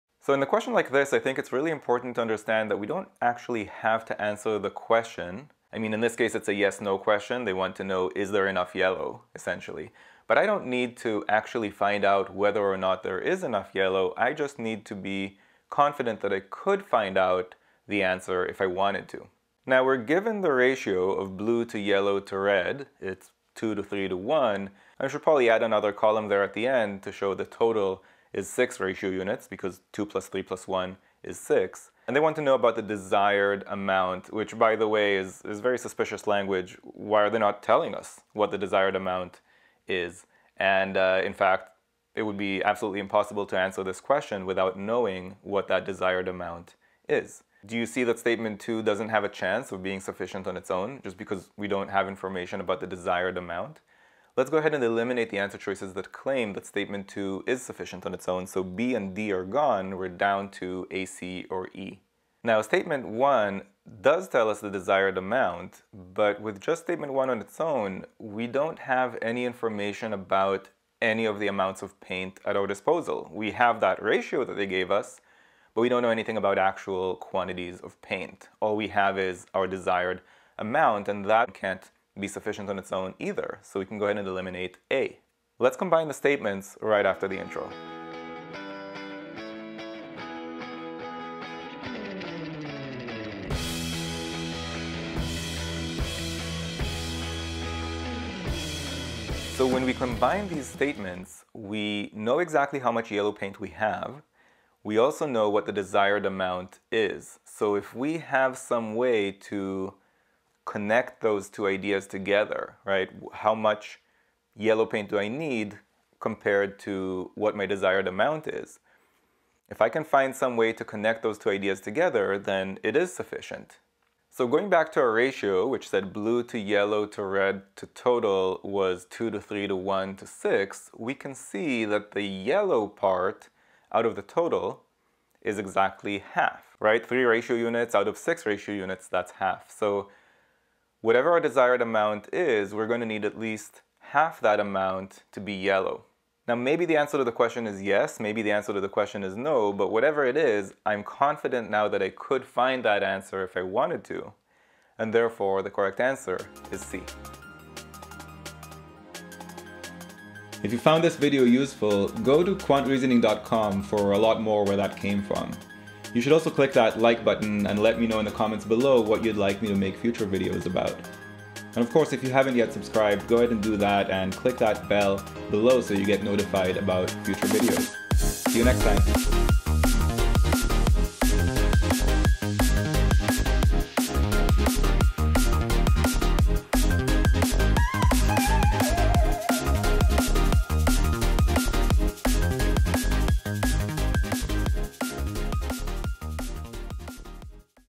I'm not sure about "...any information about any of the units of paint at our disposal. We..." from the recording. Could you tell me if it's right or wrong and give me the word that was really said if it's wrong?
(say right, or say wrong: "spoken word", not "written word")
wrong: "amounts", not "units".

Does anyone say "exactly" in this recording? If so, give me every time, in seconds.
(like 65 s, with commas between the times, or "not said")
102 s, 135 s.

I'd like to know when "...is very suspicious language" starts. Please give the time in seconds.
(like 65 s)
35 s.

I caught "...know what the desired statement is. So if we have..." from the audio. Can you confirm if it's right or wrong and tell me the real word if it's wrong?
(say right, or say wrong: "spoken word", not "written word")
wrong: "amount", not "statement".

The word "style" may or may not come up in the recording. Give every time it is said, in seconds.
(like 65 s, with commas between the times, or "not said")
not said.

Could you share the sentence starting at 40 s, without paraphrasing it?
And uh, in fact, it would be absolutely impossible to answer this question without knowing what that desired amount is.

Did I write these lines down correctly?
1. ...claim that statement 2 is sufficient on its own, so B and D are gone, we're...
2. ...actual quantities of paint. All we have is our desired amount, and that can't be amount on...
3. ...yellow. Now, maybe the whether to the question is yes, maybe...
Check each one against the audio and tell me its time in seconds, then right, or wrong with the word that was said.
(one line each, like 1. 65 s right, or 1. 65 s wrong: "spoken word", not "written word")
1. 56 s right
2. 76 s wrong: "sufficient", not "amount"
3. 145 s wrong: "answer", not "whether".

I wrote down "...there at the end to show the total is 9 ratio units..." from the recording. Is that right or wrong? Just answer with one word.
wrong.